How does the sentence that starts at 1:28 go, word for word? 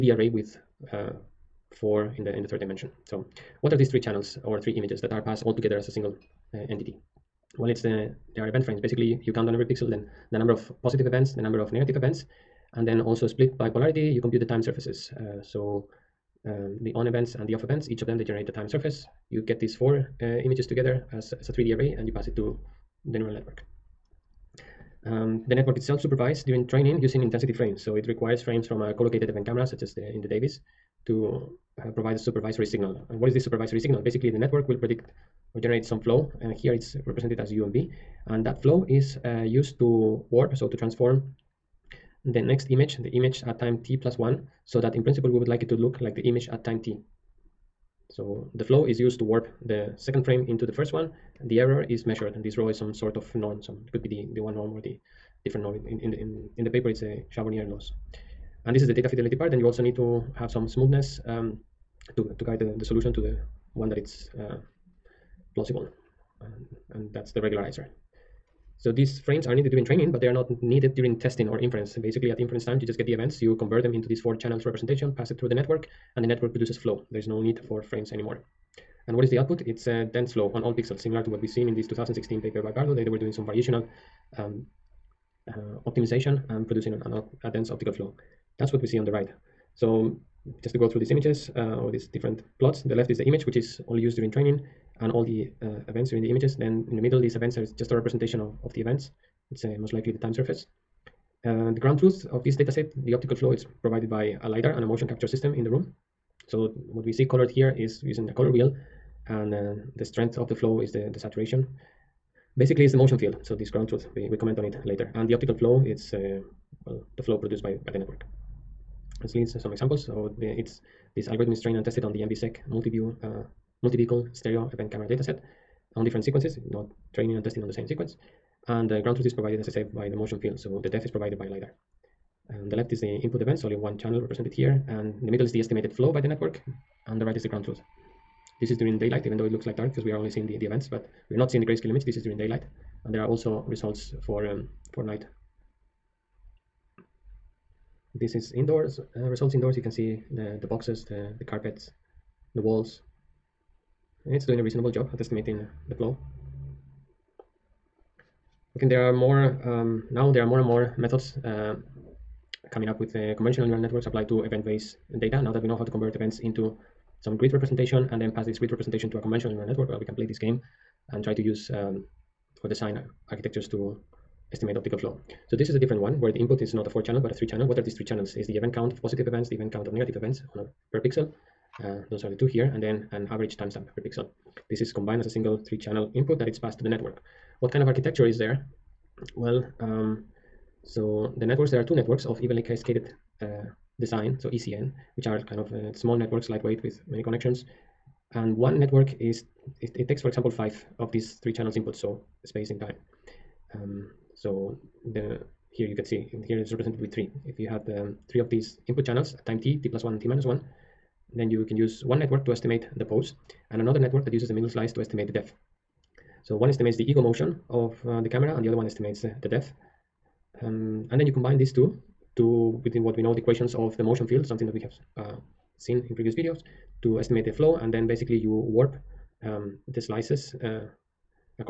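That's what we see on the right.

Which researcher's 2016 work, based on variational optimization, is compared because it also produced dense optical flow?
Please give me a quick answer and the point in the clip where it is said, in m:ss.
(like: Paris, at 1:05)
Bardow, at 1:22.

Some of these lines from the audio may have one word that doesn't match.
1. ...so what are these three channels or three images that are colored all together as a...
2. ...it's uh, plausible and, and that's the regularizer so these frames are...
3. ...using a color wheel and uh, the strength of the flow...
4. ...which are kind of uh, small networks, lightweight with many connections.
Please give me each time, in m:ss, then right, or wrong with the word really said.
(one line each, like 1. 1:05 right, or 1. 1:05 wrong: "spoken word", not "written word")
1. 0:03 wrong: "passed", not "colored"
2. 1:03 right
3. 1:48 right
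4. 3:15 right.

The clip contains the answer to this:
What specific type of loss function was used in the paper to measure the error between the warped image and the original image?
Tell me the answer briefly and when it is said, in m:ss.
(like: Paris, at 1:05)
Charbonnier loss, at 0:57.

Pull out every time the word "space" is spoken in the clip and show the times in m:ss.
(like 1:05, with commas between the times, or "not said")
3:22.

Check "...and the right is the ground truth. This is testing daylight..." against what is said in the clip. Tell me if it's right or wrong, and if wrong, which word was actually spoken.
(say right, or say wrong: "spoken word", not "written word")
wrong: "during", not "testing".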